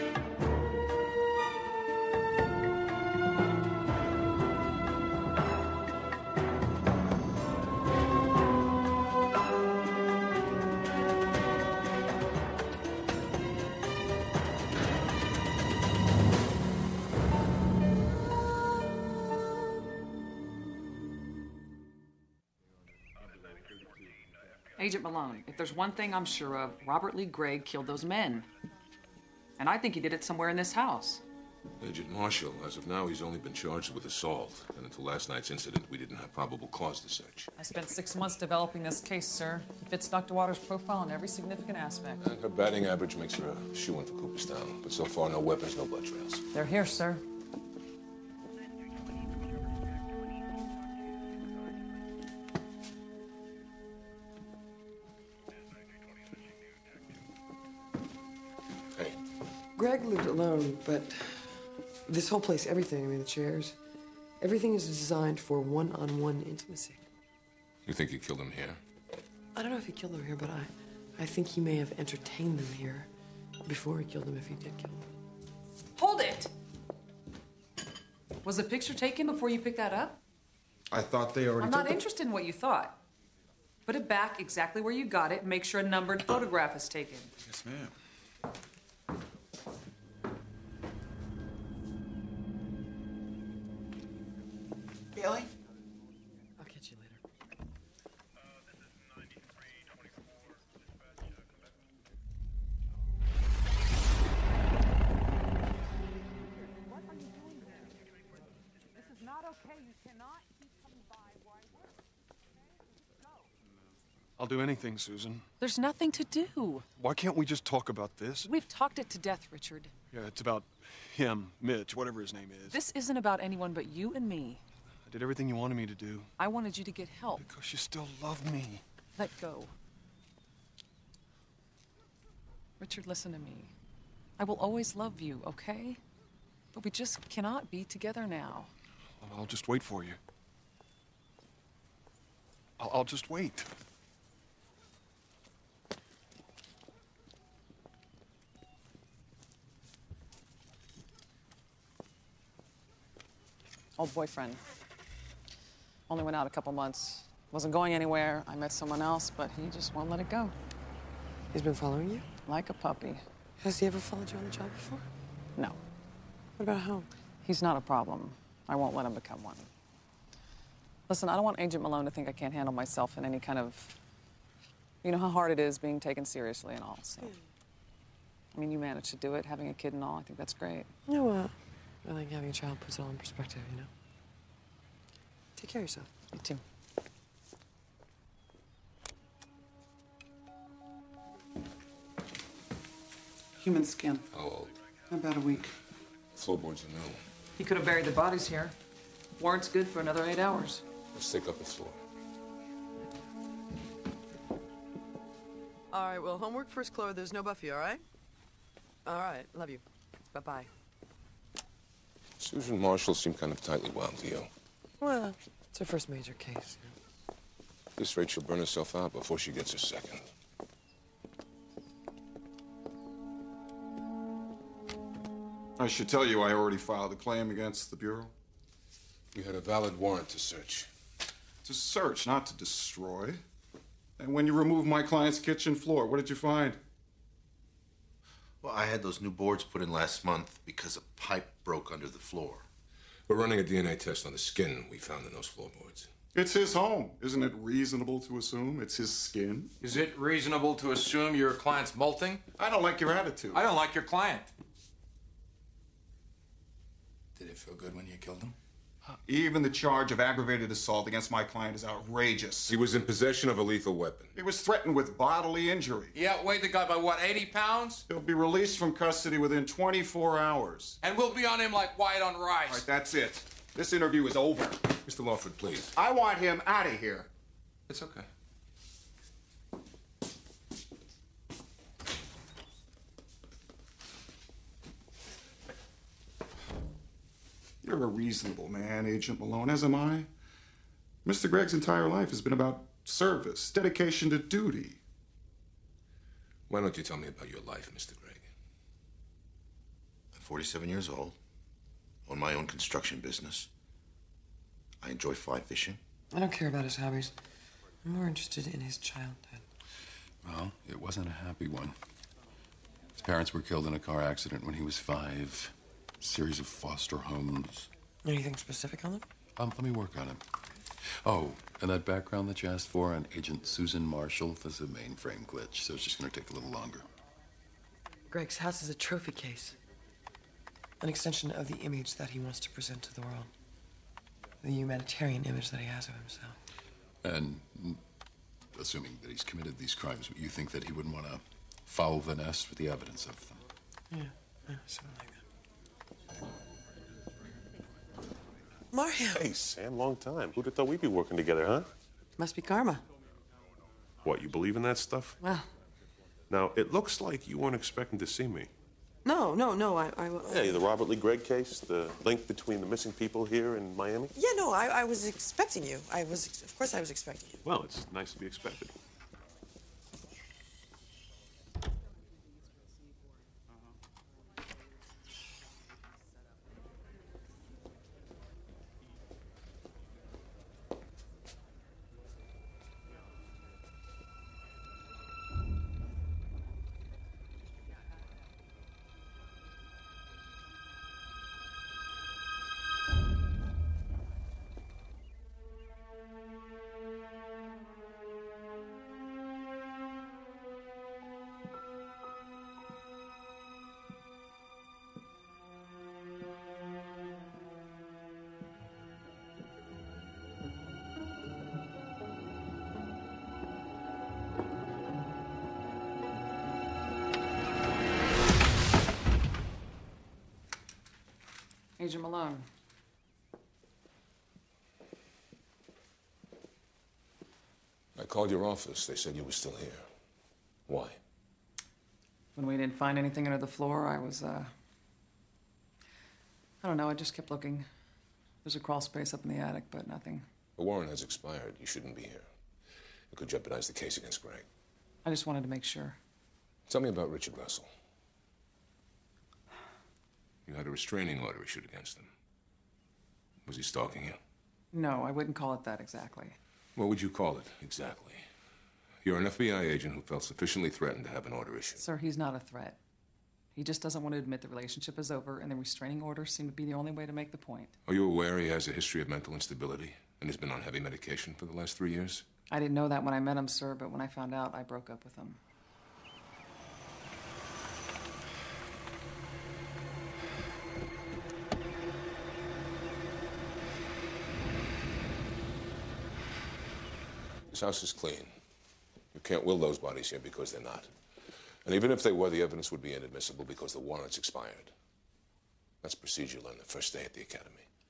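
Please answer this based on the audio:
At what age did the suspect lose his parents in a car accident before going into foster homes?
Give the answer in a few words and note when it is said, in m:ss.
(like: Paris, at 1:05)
5, at 5:14.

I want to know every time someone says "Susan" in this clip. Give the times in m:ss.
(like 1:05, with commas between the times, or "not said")
1:54, 3:32, 5:23.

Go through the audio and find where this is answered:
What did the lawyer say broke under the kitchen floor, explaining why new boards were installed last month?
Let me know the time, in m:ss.
4:00.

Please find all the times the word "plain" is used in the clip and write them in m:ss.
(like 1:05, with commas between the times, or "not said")
not said.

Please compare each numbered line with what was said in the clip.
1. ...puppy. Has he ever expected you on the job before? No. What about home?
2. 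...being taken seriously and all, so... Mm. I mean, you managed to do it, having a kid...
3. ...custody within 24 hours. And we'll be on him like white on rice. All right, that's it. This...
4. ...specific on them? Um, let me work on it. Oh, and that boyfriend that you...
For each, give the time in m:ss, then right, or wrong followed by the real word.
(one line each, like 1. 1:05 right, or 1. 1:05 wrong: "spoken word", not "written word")
1. 2:42 wrong: "followed", not "expected"
2. 2:55 right
3. 4:28 right
4. 5:18 wrong: "background", not "boyfriend".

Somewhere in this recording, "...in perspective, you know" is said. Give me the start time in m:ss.
3:03.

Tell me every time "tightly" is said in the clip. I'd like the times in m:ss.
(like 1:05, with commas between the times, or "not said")
3:33.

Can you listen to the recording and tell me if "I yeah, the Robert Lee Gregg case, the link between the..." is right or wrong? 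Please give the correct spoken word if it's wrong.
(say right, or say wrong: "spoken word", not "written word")
right.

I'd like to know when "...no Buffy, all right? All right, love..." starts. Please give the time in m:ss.
3:27.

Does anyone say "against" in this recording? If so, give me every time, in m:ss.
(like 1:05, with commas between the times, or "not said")
3:47, 4:21, 7:24, 7:31.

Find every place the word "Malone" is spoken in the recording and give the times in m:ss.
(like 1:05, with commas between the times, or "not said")
0:25, 2:51, 4:49, 7:02.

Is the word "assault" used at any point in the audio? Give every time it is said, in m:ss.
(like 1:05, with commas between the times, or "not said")
0:34, 4:20.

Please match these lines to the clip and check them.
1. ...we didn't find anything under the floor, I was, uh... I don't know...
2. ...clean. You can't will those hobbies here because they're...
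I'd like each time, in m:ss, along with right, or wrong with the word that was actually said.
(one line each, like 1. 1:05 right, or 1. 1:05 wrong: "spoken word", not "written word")
1. 7:12 right
2. 8:08 wrong: "bodies", not "hobbies".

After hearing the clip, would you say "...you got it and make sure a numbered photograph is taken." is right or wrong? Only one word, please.
right.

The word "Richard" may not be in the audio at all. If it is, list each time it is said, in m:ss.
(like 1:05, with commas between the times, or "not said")
1:59, 2:12, 7:27.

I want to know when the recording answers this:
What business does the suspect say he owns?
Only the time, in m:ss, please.
5:02.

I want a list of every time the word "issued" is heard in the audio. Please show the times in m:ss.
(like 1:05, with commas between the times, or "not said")
7:31, 7:41.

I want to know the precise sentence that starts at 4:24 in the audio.
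He was threatened with bodily injury.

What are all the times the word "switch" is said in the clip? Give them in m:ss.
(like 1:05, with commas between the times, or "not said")
not said.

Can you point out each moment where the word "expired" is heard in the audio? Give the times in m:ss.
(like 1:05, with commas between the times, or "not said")
7:21, 8:14.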